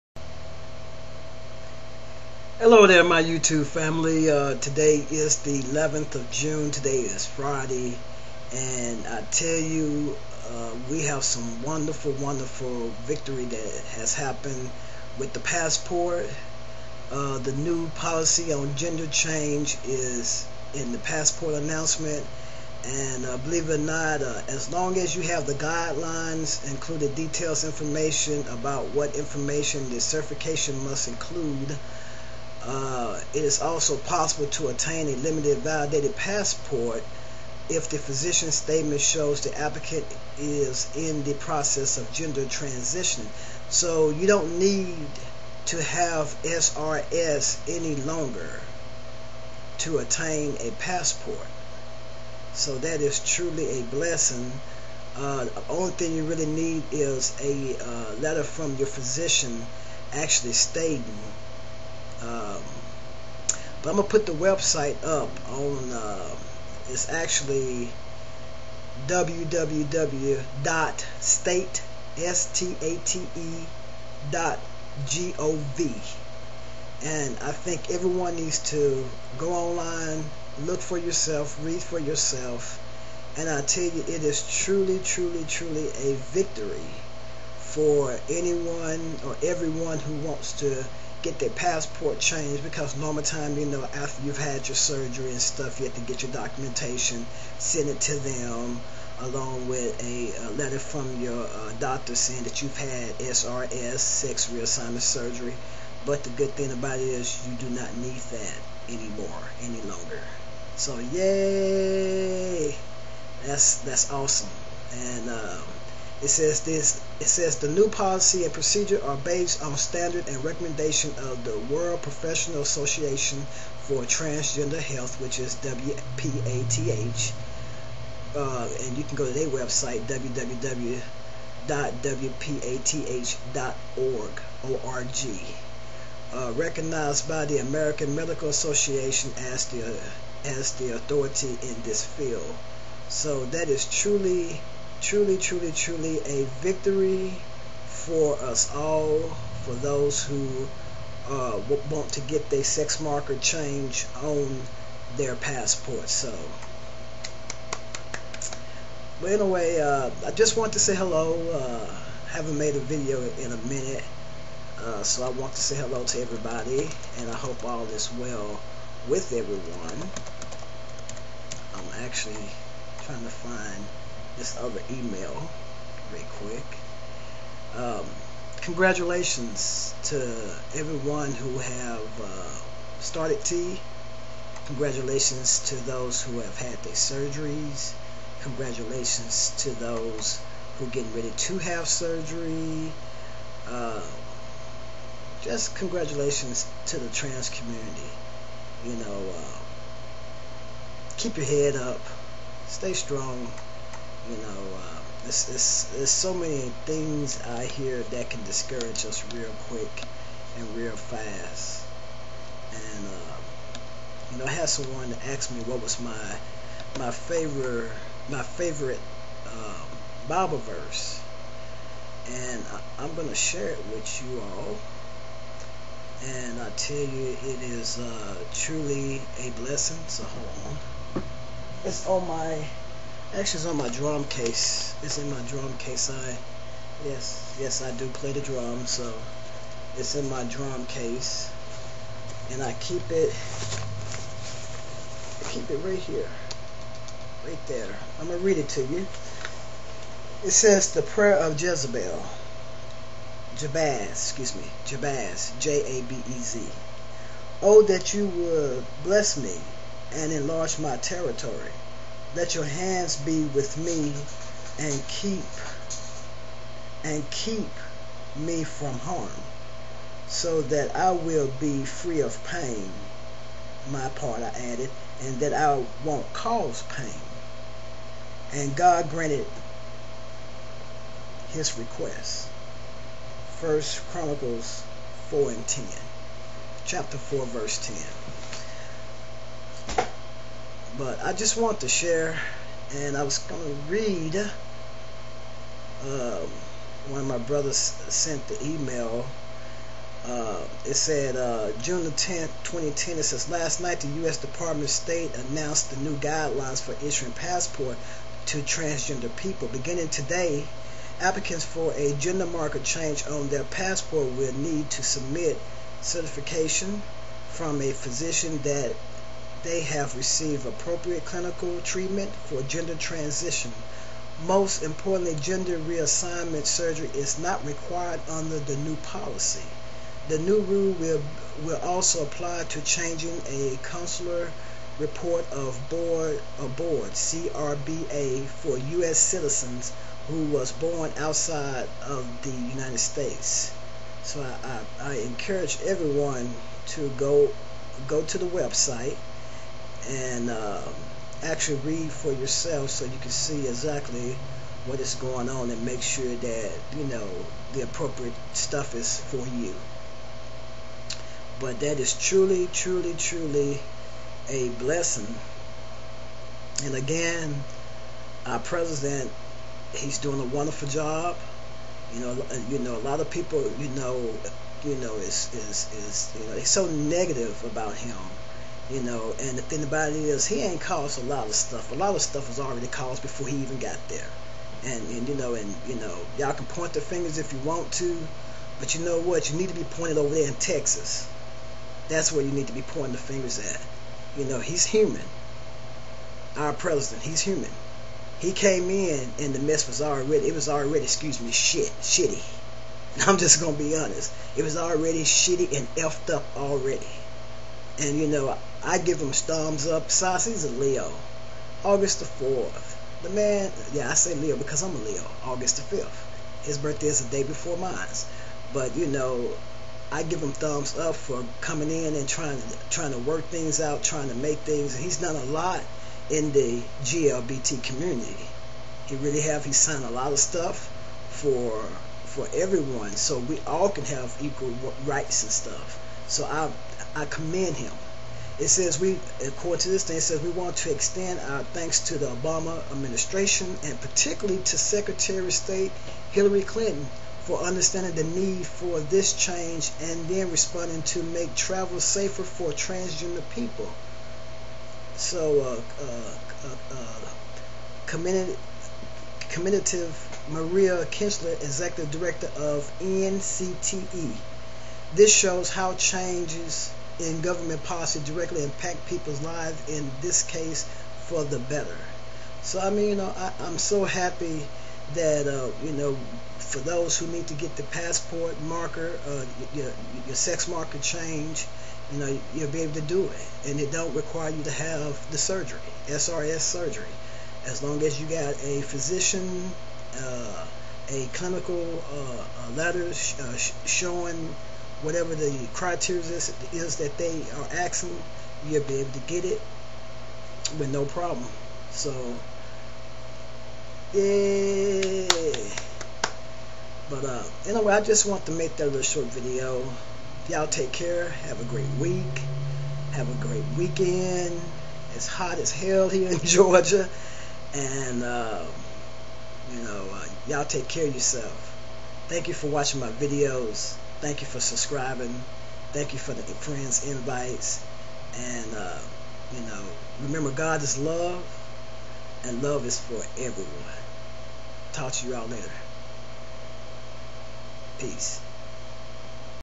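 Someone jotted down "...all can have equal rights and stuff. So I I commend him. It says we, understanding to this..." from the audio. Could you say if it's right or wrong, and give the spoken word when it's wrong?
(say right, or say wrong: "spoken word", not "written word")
wrong: "according", not "understanding".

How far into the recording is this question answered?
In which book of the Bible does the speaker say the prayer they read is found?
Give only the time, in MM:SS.
04:43.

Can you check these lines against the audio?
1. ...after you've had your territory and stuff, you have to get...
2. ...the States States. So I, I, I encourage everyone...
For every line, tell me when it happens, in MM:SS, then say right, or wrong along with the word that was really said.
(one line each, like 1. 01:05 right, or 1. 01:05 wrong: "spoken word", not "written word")
1. 01:33 wrong: "surgery", not "territory"
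2. 05:42 wrong: "United", not "States".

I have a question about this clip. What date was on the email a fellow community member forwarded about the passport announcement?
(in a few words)
June 10, 2010.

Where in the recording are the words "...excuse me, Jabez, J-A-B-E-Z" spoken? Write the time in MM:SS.
04:14.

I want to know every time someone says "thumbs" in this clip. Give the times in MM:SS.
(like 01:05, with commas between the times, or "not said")
06:49, 07:00.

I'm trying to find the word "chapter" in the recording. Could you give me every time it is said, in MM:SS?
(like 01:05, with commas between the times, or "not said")
04:46.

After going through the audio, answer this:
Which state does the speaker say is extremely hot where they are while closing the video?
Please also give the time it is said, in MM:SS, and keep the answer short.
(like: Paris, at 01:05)
Georgia, at 08:36.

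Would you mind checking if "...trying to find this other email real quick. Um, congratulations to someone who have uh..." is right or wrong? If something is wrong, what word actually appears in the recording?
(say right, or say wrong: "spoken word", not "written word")
wrong: "everyone", not "someone".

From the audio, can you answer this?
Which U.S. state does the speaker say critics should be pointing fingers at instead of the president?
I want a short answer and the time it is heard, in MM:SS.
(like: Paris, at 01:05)
Texas, at 06:30.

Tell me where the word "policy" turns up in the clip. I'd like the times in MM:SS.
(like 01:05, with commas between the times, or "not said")
00:17, 01:57, 05:28, 07:47.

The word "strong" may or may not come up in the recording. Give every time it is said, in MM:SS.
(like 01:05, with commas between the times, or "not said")
03:22.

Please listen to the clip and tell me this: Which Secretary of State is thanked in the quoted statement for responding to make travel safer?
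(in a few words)
Hillary Clinton.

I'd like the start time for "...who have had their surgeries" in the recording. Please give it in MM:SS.
03:06.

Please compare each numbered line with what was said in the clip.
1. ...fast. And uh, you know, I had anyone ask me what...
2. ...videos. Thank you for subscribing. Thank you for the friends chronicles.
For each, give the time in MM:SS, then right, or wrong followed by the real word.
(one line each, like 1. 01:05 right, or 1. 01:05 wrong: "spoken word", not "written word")
1. 03:30 wrong: "someone", not "anyone"
2. 08:43 wrong: "invites", not "chronicles".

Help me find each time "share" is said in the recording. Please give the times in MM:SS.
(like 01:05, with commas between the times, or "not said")
03:43, 04:51.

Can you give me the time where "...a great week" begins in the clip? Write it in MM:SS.
08:31.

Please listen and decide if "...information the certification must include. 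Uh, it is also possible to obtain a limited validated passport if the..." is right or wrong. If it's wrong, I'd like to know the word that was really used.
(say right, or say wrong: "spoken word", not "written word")
right.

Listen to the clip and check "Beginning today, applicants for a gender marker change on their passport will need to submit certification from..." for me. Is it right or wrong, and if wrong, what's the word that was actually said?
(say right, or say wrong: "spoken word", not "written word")
right.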